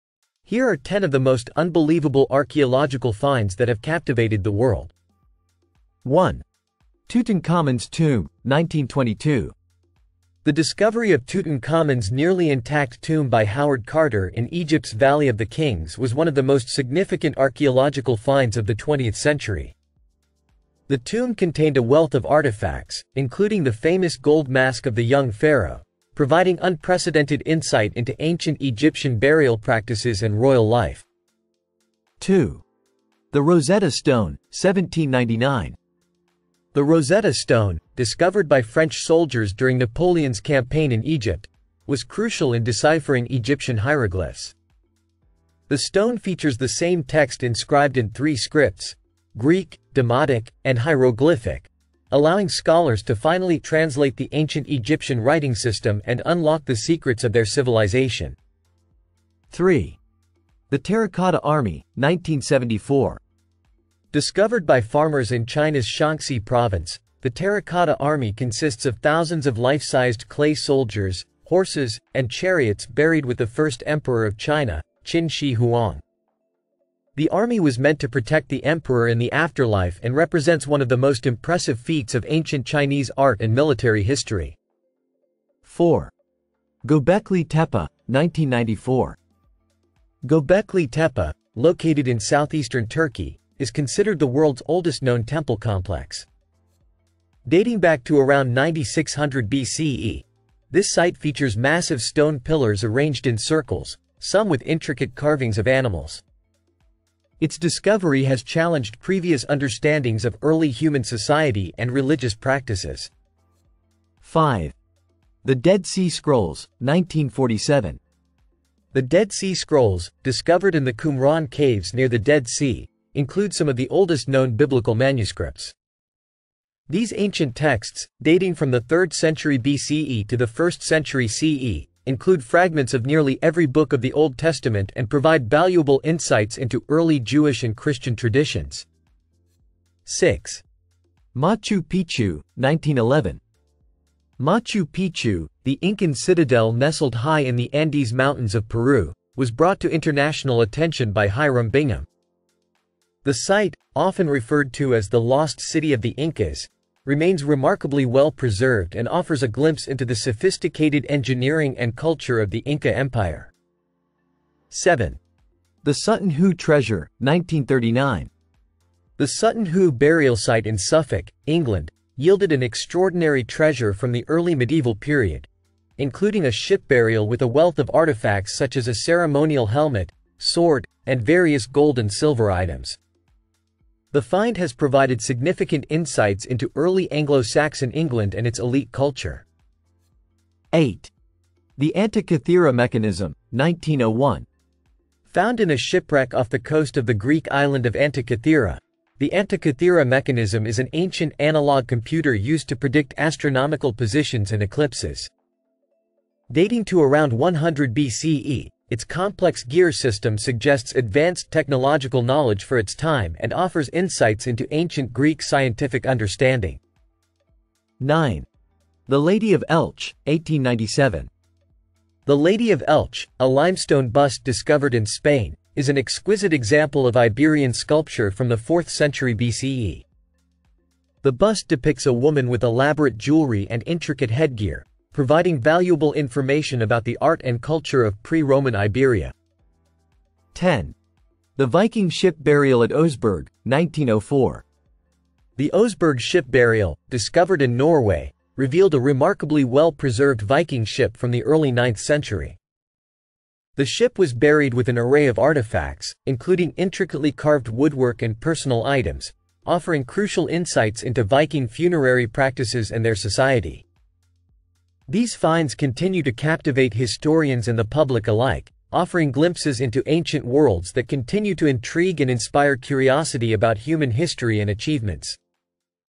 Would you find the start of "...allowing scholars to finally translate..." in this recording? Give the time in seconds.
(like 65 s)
52 s.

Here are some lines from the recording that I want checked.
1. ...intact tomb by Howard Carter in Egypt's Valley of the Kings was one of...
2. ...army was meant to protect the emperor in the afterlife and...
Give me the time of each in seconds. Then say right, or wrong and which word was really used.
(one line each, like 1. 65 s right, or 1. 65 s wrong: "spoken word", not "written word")
1. 12 s right
2. 77 s right.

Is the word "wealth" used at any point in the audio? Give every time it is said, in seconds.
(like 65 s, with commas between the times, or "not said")
21 s, 177 s.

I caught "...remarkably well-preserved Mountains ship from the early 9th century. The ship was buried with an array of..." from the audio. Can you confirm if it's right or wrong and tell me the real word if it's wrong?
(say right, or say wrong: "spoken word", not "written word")
wrong: "Viking", not "Mountains".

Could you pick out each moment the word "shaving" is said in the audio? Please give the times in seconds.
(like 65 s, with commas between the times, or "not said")
not said.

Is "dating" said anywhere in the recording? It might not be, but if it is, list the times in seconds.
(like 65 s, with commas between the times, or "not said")
97 s, 128 s, 206 s.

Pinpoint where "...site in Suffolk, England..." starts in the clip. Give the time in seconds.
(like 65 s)
170 s.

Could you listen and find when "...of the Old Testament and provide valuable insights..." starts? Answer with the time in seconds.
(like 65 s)
133 s.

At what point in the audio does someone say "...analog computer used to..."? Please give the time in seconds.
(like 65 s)
201 s.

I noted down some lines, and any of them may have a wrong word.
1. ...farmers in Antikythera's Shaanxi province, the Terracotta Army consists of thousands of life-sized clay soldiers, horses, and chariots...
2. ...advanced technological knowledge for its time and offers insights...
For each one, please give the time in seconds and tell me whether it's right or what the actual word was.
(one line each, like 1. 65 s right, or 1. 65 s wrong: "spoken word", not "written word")
1. 64 s wrong: "China", not "Antikythera"
2. 210 s right.